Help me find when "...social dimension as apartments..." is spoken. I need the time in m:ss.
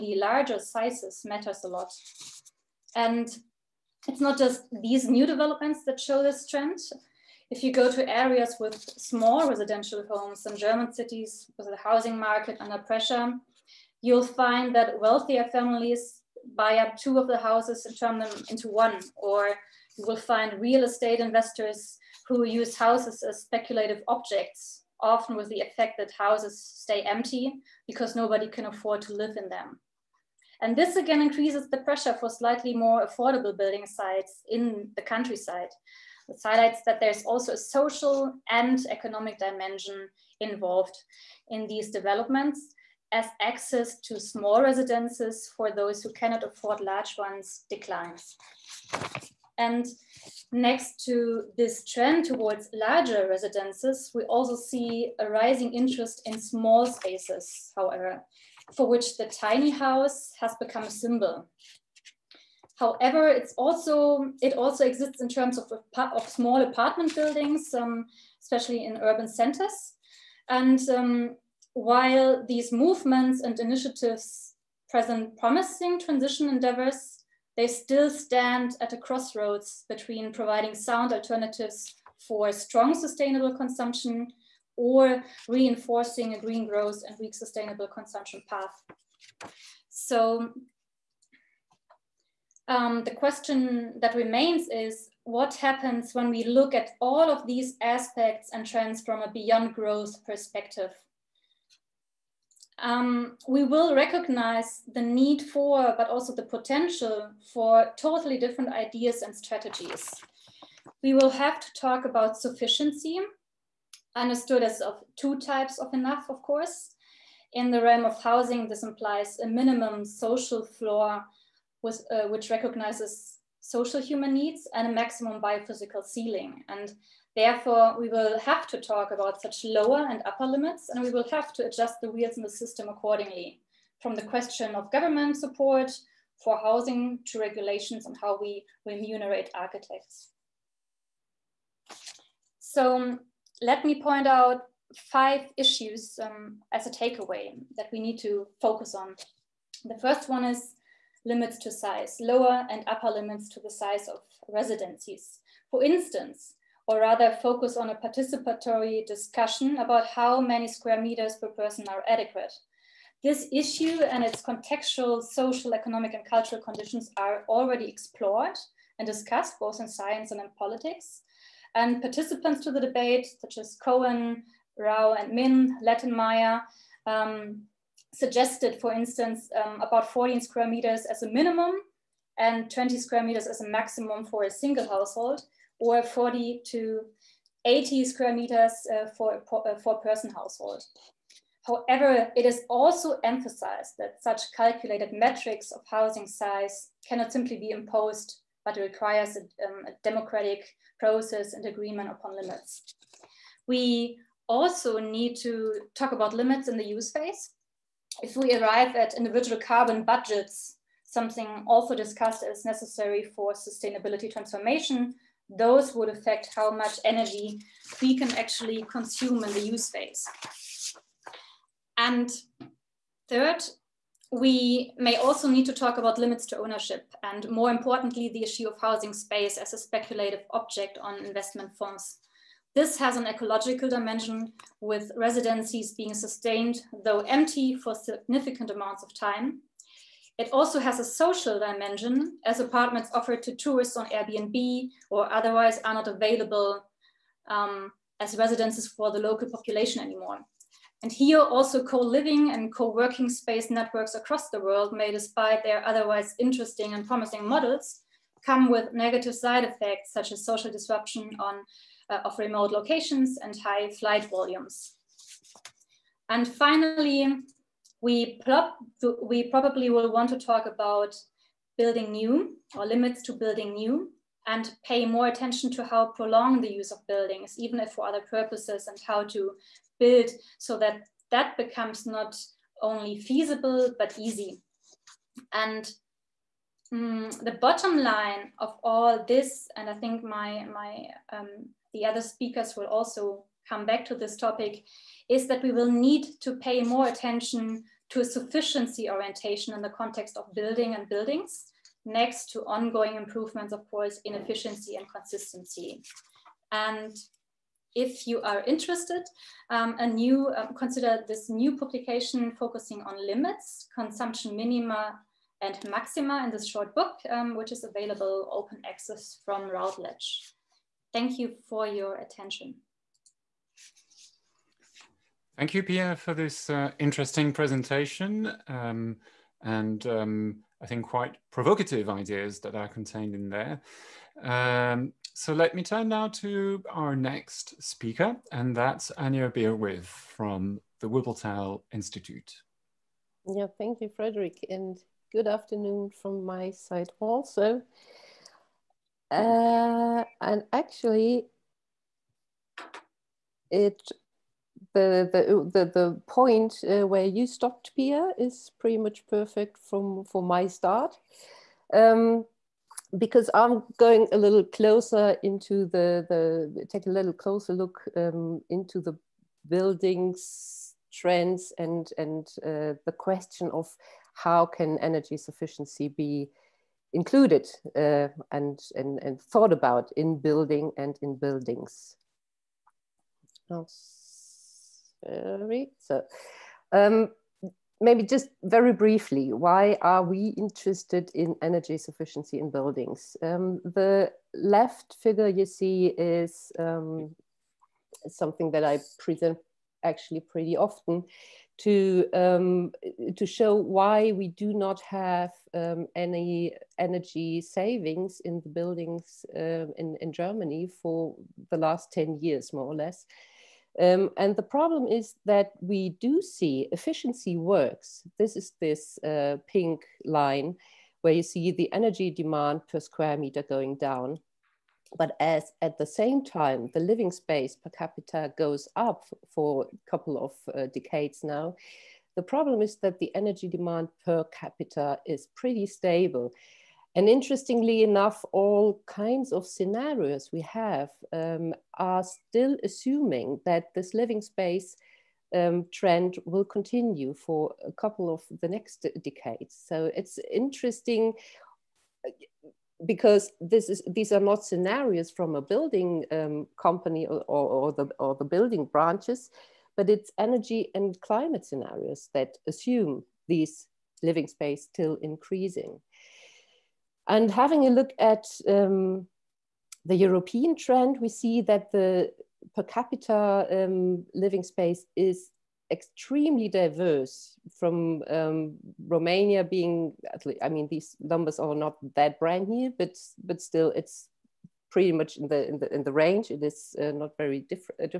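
4:01.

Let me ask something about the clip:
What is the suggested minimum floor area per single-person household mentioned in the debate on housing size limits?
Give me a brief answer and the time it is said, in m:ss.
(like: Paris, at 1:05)
14 square meters, at 3:00.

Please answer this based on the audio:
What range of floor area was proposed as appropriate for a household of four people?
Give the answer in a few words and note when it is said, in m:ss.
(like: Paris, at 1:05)
40 to 80 square meters, at 3:06.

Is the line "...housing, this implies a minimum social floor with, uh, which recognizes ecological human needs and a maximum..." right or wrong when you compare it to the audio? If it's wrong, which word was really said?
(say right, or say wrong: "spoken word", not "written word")
wrong: "social", not "ecological".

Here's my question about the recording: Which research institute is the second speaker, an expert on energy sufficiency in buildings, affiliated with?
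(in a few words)
Wuppertal Institute.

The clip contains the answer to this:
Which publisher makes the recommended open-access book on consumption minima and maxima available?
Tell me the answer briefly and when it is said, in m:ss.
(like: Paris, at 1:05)
Routledge, at 5:19.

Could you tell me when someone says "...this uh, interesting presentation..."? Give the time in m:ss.
5:26.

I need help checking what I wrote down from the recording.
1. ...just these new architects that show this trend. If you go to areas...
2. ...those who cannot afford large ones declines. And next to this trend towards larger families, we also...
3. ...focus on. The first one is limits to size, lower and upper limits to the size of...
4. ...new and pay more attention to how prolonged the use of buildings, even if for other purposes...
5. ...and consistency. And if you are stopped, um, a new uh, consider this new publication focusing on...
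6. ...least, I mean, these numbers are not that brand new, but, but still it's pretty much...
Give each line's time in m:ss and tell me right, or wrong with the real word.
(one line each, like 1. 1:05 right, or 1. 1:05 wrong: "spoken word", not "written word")
1. 0:04 wrong: "developments", not "architects"
2. 0:45 wrong: "residences", not "families"
3. 2:28 right
4. 4:33 right
5. 5:04 wrong: "interested", not "stopped"
6. 8:00 right.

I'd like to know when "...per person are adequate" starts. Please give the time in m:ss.
2:41.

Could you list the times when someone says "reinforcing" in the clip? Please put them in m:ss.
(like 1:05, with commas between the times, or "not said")
1:25.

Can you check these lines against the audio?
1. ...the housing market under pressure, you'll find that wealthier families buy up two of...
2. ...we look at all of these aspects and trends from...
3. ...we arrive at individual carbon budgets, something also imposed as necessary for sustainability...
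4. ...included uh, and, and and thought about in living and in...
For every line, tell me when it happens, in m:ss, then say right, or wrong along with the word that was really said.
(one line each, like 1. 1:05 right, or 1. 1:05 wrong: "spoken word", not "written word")
1. 0:11 right
2. 1:36 right
3. 3:28 wrong: "discussed", not "imposed"
4. 6:17 wrong: "building", not "living".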